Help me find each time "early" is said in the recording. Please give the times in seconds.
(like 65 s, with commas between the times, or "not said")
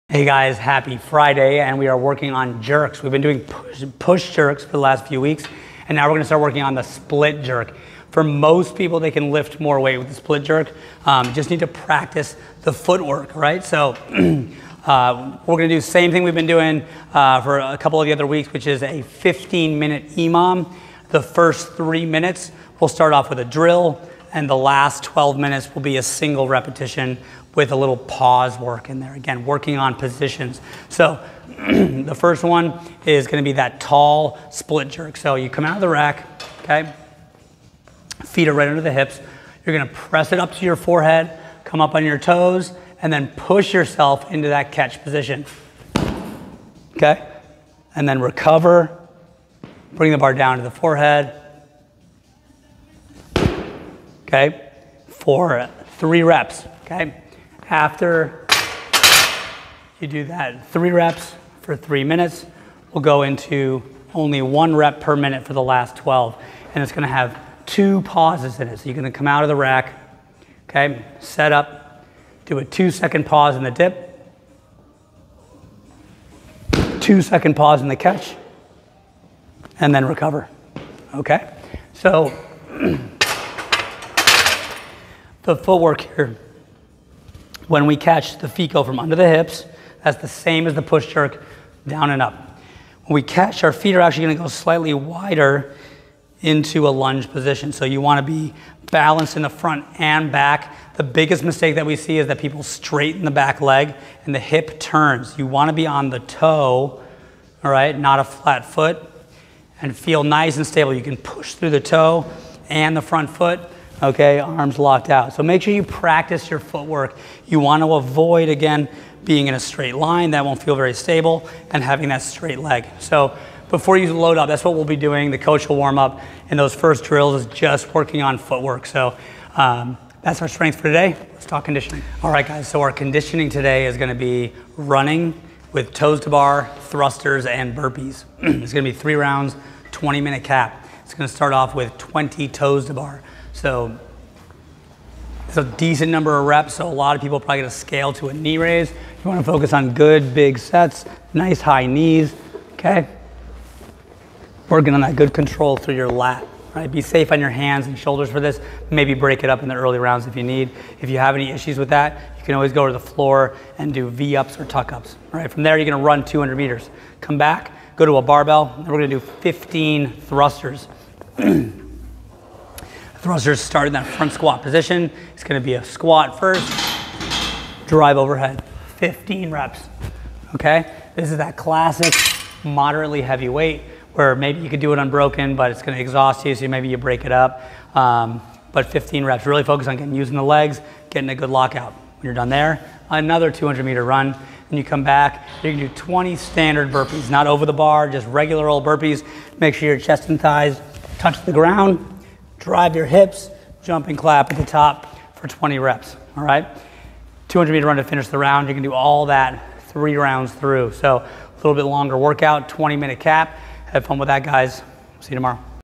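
159 s.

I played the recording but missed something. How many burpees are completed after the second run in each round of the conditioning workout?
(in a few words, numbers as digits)
20.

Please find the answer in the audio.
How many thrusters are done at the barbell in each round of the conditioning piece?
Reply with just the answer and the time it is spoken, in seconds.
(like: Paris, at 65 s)
15, at 169 s.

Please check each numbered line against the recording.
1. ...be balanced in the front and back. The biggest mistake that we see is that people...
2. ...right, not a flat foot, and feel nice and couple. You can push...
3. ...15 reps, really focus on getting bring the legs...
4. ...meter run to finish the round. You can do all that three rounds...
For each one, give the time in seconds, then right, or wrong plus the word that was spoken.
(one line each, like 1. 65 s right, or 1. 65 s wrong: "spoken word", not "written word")
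1. 98 s right
2. 107 s wrong: "stable", not "couple"
3. 188 s wrong: "using", not "bring"
4. 207 s right.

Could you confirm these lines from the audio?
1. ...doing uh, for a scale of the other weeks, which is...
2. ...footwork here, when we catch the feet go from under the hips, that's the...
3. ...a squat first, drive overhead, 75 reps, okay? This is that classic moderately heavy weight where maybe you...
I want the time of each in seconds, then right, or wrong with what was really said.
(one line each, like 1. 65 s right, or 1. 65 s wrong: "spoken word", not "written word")
1. 16 s wrong: "couple", not "scale"
2. 85 s right
3. 175 s wrong: "15", not "75".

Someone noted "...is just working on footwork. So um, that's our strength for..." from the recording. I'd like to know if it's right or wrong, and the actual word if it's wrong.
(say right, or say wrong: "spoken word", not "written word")
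right.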